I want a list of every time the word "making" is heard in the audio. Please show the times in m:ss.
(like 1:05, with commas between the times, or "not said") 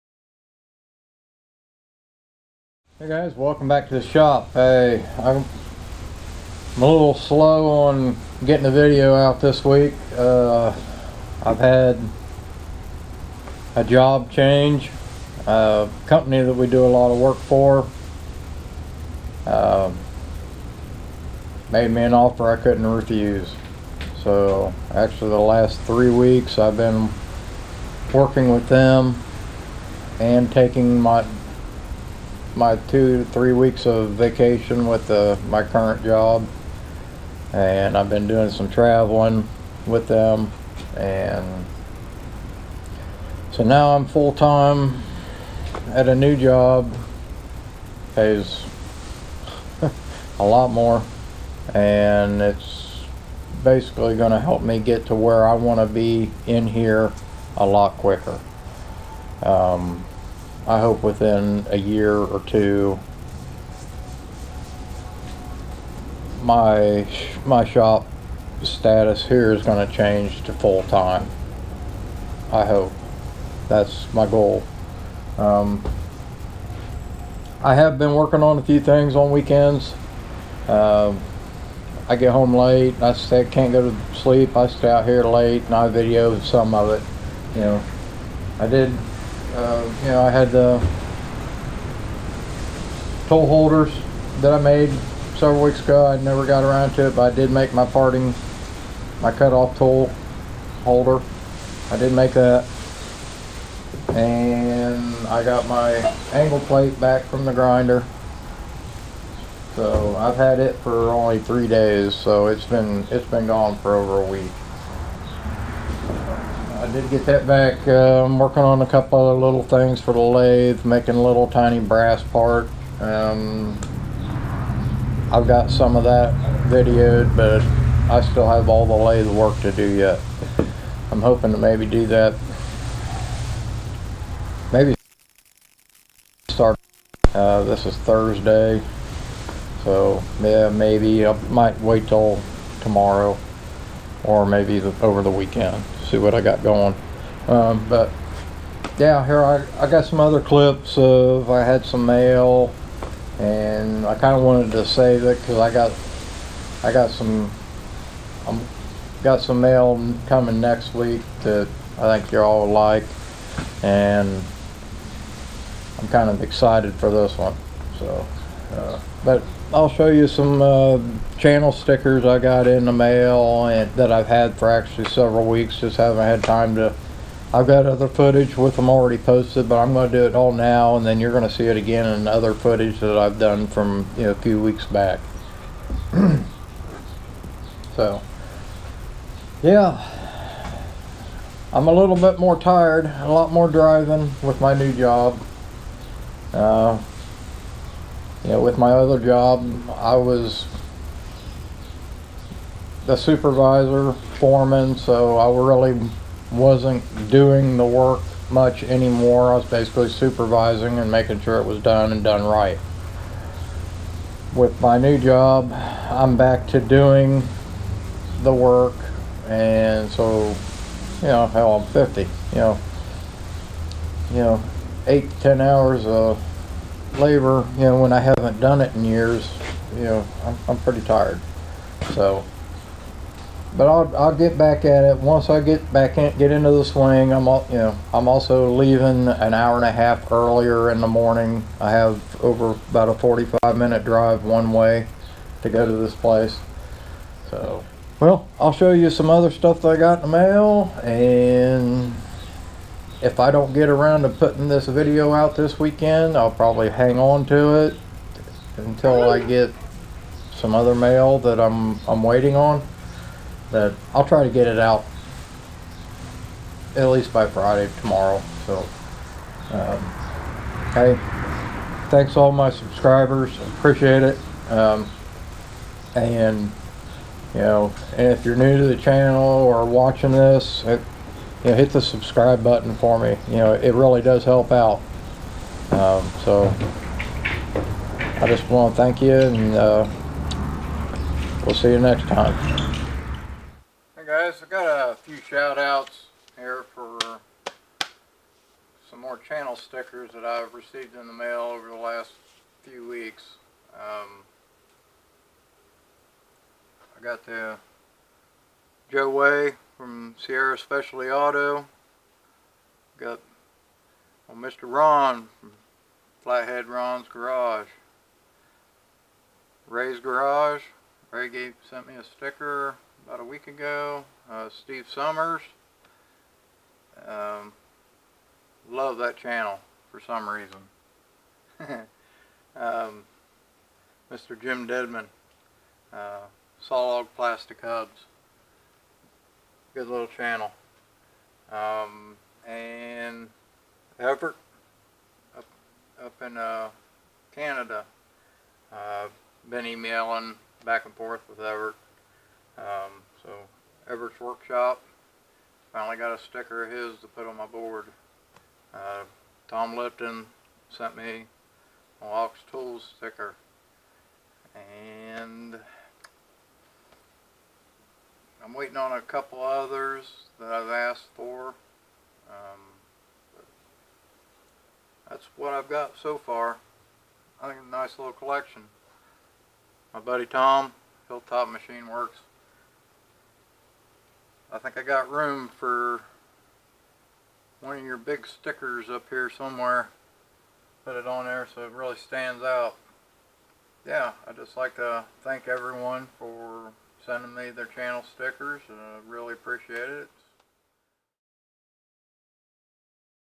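2:00, 3:31.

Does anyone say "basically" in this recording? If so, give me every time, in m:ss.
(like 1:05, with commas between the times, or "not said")
0:53, 3:29.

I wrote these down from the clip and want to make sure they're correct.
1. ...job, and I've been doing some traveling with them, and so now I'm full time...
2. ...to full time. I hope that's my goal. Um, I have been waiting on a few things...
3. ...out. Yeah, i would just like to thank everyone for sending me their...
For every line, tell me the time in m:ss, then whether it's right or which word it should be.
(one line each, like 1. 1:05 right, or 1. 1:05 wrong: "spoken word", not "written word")
1. 0:36 right
2. 1:10 wrong: "working", not "waiting"
3. 6:32 right.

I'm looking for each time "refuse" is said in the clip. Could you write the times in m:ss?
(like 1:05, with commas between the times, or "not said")
0:22.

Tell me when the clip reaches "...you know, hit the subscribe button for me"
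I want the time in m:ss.
4:41.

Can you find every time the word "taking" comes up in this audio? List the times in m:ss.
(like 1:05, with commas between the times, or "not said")
0:30.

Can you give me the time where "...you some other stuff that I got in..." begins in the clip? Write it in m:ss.
4:08.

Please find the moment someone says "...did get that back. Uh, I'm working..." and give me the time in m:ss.
1:56.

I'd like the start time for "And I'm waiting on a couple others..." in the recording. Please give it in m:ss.
6:04.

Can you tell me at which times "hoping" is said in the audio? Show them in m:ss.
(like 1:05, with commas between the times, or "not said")
2:11.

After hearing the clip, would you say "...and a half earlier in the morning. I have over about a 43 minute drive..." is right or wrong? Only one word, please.
wrong.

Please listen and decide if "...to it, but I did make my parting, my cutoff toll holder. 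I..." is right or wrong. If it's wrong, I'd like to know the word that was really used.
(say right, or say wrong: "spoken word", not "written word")
right.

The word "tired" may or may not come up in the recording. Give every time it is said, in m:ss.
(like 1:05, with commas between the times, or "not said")
3:12, 3:51.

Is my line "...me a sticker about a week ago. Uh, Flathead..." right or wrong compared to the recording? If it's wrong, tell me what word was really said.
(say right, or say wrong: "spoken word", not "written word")
wrong: "Steve", not "Flathead".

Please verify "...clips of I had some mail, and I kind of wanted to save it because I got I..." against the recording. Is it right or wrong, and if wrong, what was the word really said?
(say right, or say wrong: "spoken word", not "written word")
right.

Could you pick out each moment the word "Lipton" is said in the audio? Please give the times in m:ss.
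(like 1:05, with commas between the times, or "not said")
5:59.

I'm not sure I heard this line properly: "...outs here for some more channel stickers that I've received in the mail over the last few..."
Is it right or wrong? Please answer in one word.
right.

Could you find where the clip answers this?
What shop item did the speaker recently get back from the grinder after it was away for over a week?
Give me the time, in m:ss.
1:46.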